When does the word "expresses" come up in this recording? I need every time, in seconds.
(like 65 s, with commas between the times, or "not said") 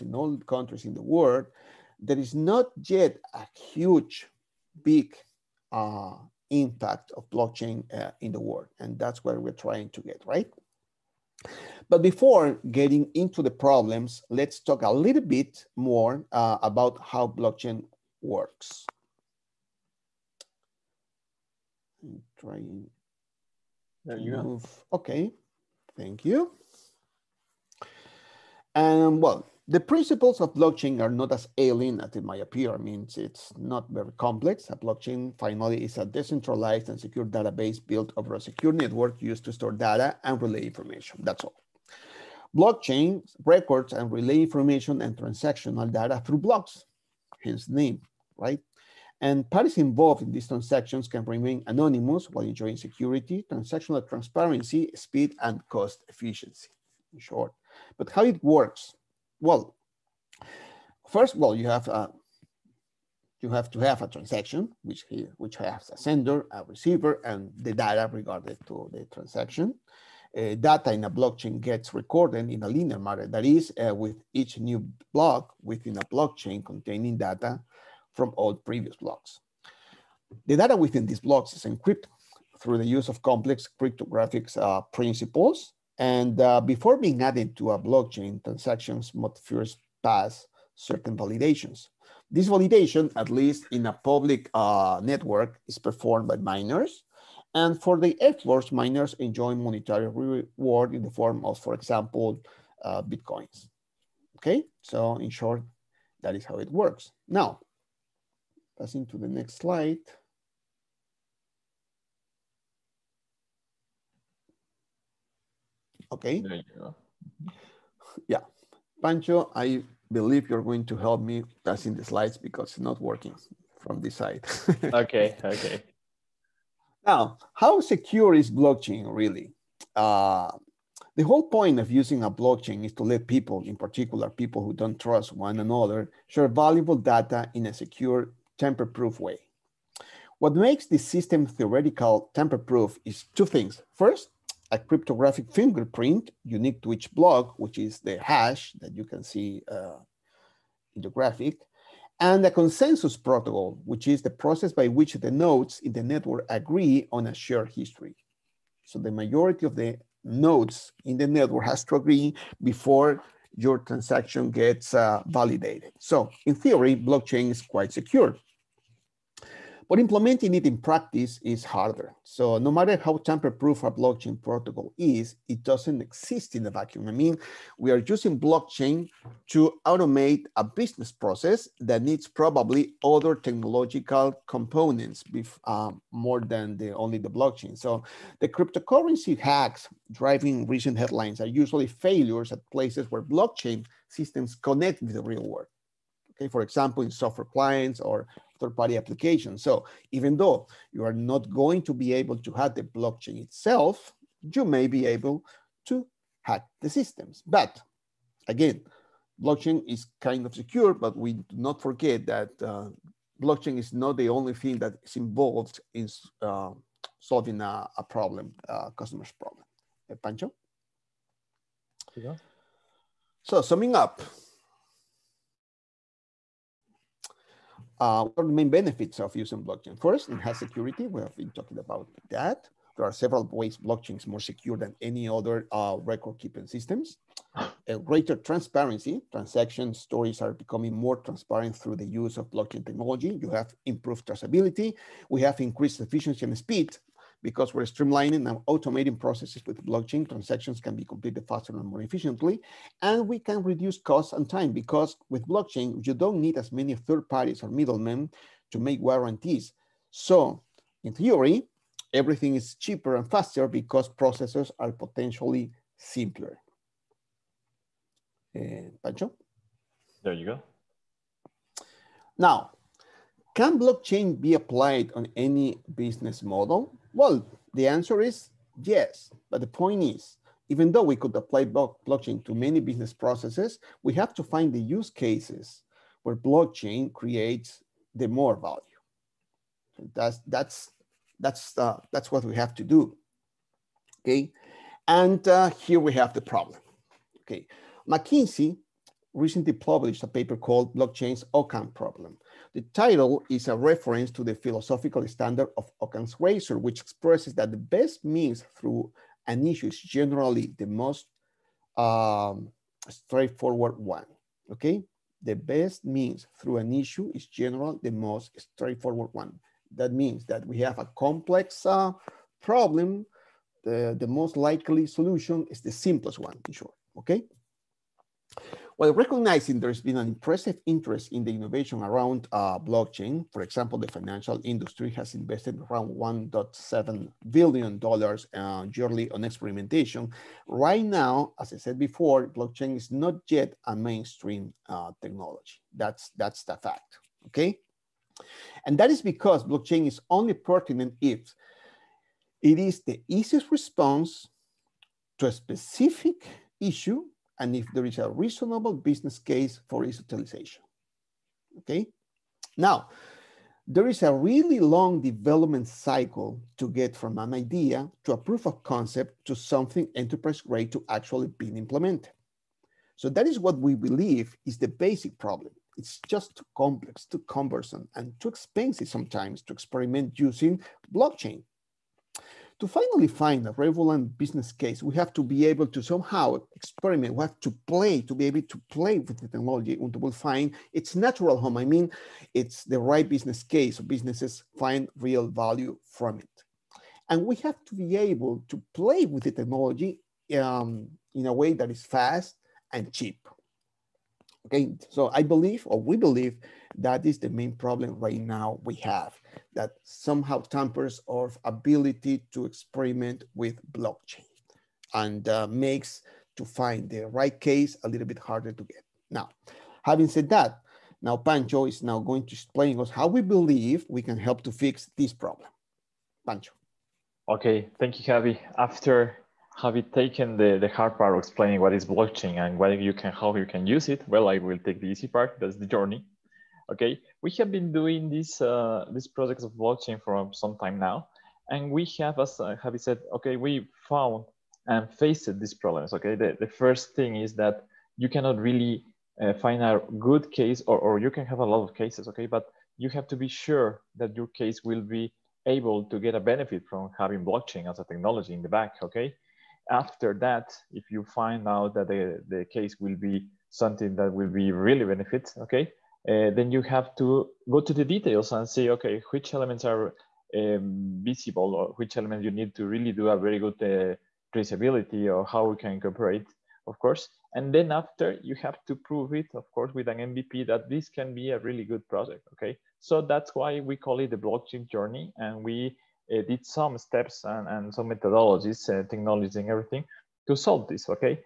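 307 s.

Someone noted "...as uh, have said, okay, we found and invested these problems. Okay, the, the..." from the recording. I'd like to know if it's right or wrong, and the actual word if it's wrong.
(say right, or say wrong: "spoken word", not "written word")
wrong: "faced", not "invested".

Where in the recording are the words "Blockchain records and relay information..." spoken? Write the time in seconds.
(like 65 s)
42 s.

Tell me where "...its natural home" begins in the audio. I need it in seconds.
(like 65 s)
390 s.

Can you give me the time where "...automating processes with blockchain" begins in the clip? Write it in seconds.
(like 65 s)
248 s.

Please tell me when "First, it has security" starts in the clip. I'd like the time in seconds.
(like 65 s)
229 s.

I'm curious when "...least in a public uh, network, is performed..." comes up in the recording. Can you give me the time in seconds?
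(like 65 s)
93 s.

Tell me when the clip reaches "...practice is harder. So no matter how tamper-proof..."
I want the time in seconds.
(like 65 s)
170 s.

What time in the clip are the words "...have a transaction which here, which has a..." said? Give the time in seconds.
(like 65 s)
63 s.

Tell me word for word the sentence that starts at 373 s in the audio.
So that is what we believe is the basic problem.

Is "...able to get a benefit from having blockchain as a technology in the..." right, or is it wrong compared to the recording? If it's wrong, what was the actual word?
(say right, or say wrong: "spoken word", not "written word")
right.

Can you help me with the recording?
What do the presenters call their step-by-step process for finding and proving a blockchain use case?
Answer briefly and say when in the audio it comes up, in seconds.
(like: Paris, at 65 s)
The blockchain journey, at 484 s.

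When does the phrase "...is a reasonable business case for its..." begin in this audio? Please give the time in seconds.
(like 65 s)
358 s.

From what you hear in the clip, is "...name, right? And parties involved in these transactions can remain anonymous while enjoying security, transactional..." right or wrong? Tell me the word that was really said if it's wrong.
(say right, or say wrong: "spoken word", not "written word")
right.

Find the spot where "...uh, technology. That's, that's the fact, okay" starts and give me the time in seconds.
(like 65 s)
344 s.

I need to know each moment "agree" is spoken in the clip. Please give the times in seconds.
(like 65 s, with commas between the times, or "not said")
156 s, 161 s.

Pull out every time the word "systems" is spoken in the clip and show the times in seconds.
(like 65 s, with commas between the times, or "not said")
141 s, 194 s, 206 s, 236 s.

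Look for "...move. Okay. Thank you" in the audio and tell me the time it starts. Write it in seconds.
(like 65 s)
24 s.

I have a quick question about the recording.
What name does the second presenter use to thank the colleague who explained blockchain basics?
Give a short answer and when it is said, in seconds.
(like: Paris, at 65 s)
Javi, at 428 s.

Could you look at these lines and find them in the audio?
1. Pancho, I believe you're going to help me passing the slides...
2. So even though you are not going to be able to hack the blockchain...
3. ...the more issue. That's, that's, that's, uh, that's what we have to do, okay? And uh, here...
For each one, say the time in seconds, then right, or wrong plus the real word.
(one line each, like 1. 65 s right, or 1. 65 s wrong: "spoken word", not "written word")
1. 119 s right
2. 199 s right
3. 288 s wrong: "value", not "issue".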